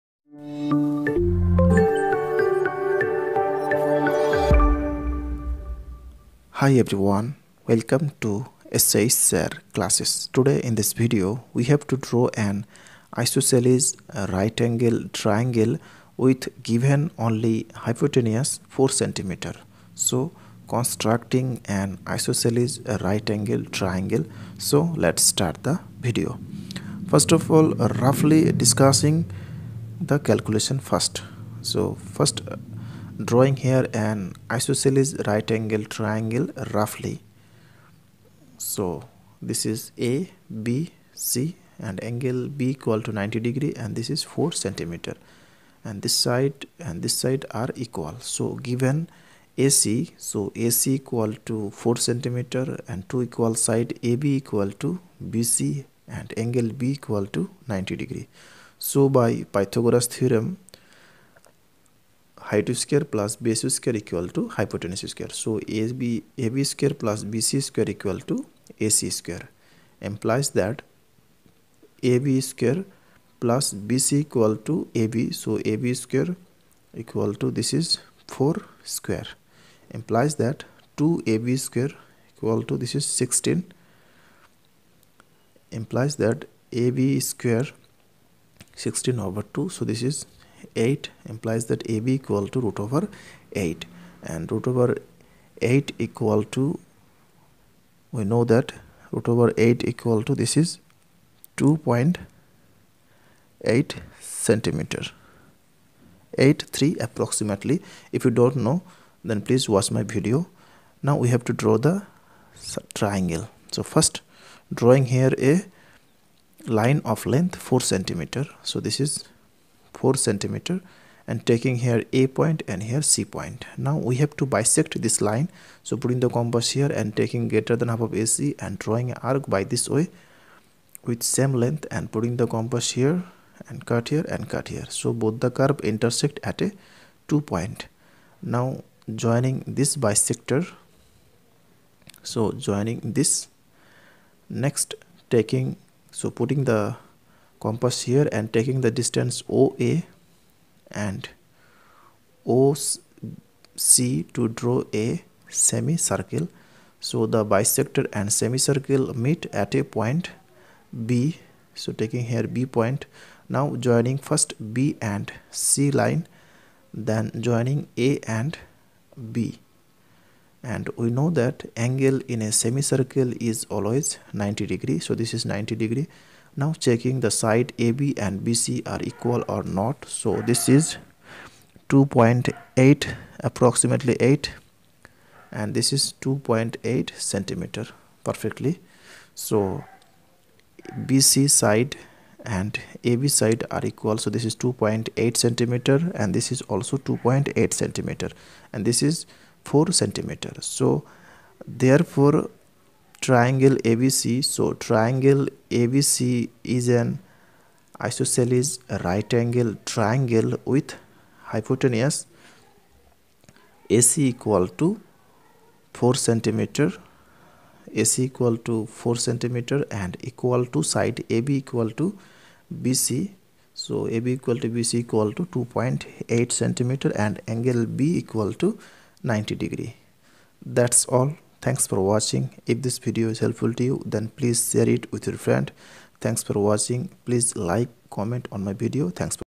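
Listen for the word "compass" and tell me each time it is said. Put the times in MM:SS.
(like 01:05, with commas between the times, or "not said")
02:06, 02:12, 02:27.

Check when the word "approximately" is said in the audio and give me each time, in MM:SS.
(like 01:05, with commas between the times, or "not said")
01:46, 03:03.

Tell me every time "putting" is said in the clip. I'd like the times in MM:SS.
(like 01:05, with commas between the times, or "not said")
02:05, 02:12, 02:26.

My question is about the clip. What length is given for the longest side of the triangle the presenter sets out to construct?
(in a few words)
4 cm.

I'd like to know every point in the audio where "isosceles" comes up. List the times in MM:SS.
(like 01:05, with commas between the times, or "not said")
00:13, 00:22, 00:34, 03:28.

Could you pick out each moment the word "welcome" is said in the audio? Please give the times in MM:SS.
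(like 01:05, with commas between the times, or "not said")
00:07.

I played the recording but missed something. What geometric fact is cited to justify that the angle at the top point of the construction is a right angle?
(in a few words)
angle in a semicircle.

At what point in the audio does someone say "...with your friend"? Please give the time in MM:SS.
03:55.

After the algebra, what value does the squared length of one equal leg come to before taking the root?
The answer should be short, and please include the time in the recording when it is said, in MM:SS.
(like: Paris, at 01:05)
8, at 01:28.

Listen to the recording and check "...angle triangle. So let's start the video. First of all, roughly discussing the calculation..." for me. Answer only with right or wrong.
right.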